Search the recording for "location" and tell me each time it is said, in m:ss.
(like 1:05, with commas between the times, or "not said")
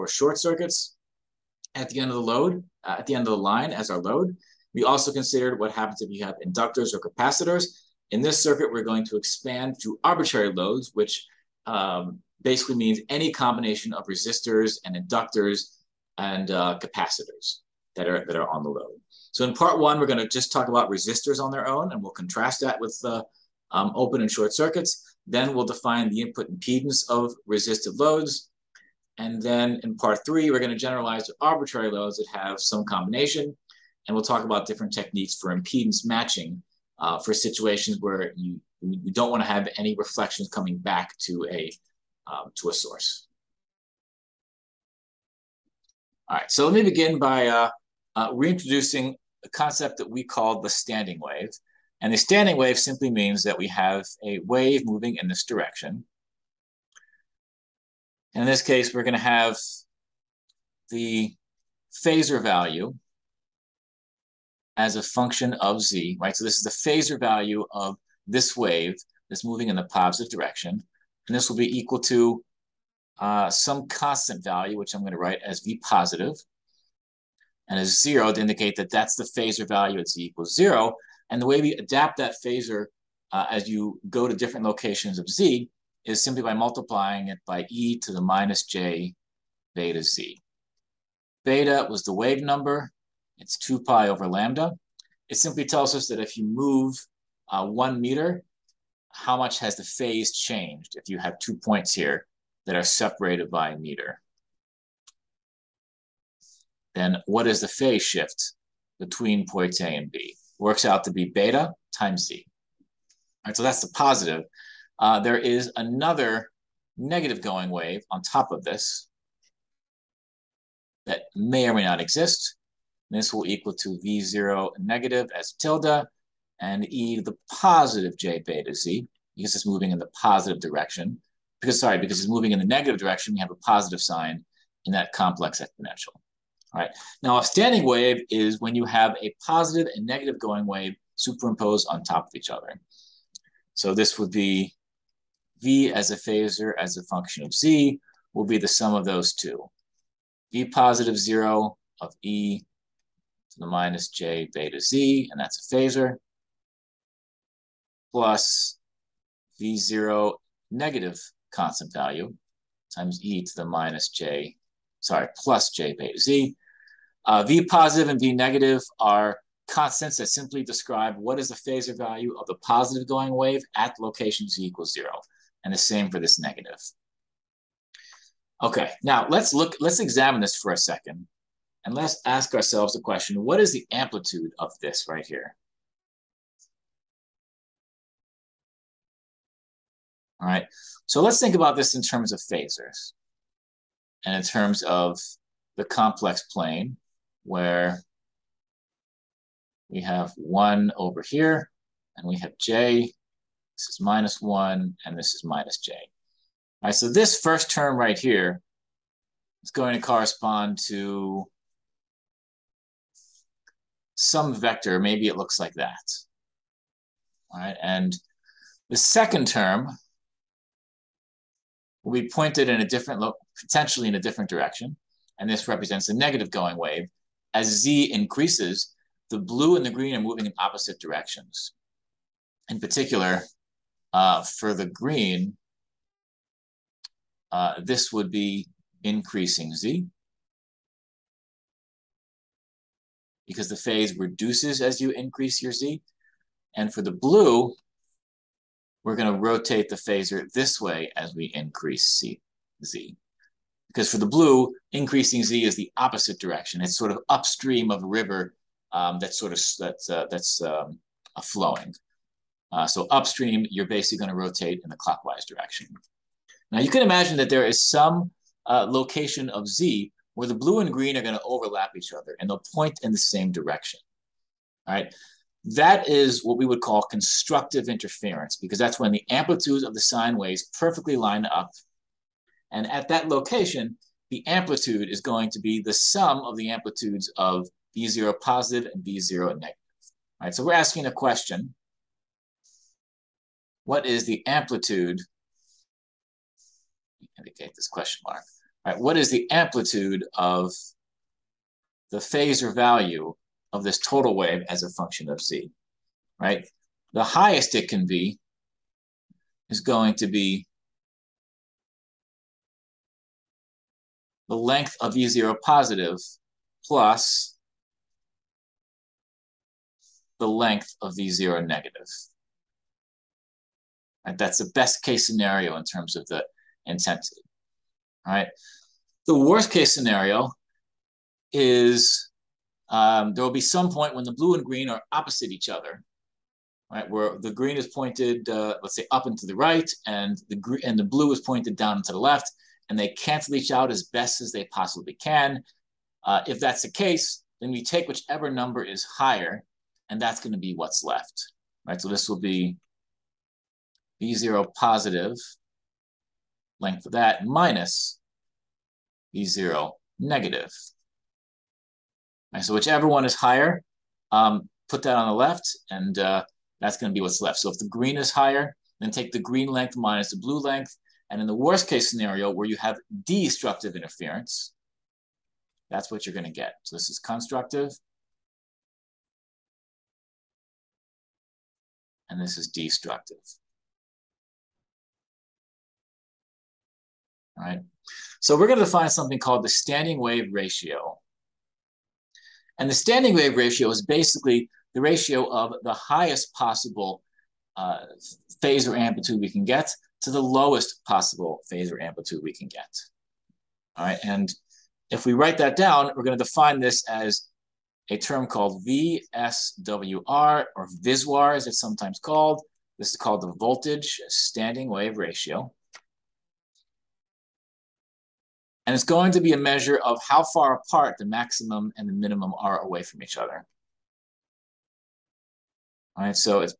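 1:24, 2:53, 4:28, 4:43.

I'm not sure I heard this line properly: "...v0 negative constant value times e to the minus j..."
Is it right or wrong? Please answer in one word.
right.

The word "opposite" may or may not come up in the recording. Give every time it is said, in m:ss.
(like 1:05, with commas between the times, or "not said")
3:50, 4:15, 5:35.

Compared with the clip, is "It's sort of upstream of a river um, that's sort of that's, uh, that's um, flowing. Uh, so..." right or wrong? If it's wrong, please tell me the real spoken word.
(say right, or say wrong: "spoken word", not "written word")
right.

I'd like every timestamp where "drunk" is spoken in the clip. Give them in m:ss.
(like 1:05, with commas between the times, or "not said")
not said.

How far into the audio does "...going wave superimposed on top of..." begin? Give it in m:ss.
2:20.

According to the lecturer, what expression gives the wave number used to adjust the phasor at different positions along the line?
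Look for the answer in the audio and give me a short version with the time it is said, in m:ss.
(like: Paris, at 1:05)
2 pi over lambda, at 1:33.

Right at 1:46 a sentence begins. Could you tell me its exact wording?
Then what is the phase shift between points A and B?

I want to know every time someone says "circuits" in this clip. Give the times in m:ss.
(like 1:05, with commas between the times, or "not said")
0:00, 0:08, 0:24.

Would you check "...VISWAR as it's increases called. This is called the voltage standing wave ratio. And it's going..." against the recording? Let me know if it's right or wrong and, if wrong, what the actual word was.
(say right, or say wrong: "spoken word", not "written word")
wrong: "sometimes", not "increases".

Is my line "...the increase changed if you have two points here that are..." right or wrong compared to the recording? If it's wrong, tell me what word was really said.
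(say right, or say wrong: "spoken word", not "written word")
wrong: "phase", not "increase".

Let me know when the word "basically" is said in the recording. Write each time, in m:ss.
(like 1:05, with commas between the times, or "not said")
0:12, 4:23, 6:34.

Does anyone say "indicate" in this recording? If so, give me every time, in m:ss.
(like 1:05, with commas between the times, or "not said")
1:18, 4:57.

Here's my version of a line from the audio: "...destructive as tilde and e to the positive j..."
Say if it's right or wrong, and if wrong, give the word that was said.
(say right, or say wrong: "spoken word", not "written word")
wrong: "negative", not "destructive".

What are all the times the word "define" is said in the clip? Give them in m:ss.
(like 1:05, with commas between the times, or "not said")
0:25, 6:28, 6:46.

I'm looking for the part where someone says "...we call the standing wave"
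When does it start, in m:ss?
0:50.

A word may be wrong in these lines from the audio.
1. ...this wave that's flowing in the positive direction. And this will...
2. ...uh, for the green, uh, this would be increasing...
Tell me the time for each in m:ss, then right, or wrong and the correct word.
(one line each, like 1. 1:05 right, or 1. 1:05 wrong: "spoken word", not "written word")
1. 1:08 wrong: "moving", not "flowing"
2. 3:54 right.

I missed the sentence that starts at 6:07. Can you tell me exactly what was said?
So if the green is higher, then take the green length minus the blue length.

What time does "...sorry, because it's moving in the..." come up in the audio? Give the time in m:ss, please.
2:11.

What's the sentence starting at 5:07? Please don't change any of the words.
The highest it can be is going to be the length of E0 positive plus the length of v 0 negative.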